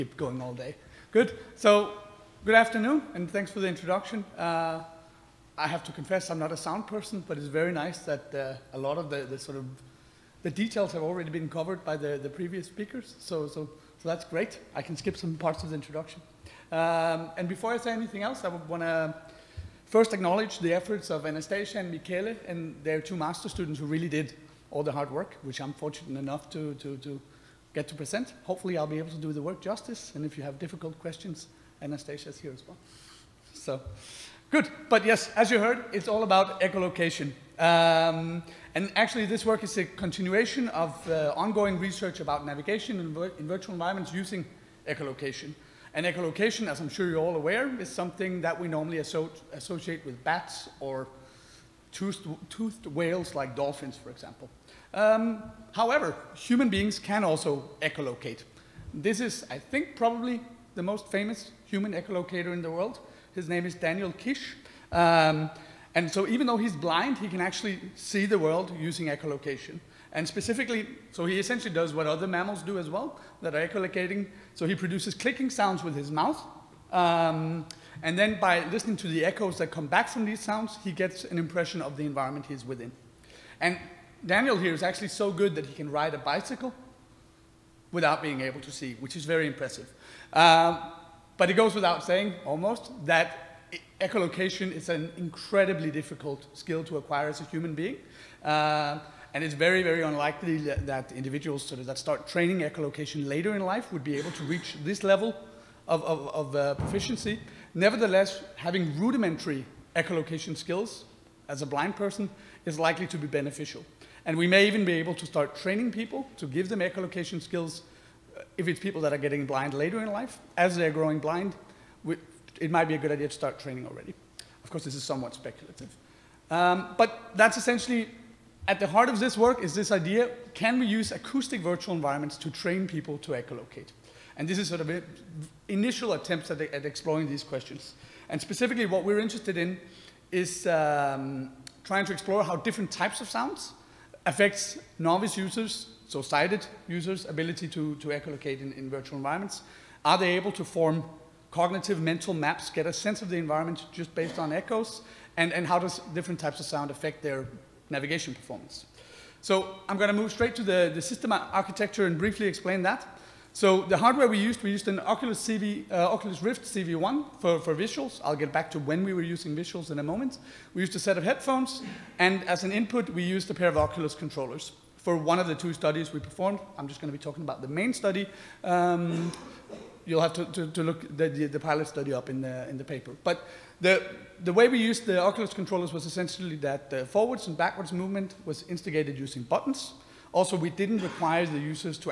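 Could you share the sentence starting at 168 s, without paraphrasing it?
I'll get back to when we were using visuals in a moment.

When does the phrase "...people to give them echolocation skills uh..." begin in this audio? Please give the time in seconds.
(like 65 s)
115 s.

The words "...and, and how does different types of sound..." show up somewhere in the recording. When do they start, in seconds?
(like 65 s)
155 s.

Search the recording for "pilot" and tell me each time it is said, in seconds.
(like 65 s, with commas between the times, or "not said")
181 s.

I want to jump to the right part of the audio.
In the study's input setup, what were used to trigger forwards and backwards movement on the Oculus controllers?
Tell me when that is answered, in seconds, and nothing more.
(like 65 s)
189 s.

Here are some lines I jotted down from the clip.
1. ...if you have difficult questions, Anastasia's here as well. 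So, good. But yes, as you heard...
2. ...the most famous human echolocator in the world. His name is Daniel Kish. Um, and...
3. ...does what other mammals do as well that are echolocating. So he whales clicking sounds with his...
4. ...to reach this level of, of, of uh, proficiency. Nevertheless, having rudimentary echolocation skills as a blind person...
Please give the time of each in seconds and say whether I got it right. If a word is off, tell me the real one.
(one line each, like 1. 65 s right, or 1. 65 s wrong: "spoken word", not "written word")
1. 30 s right
2. 60 s right
3. 71 s wrong: "produces", not "whales"
4. 104 s right.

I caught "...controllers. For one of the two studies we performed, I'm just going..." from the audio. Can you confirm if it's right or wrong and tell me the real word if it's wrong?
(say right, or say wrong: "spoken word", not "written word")
right.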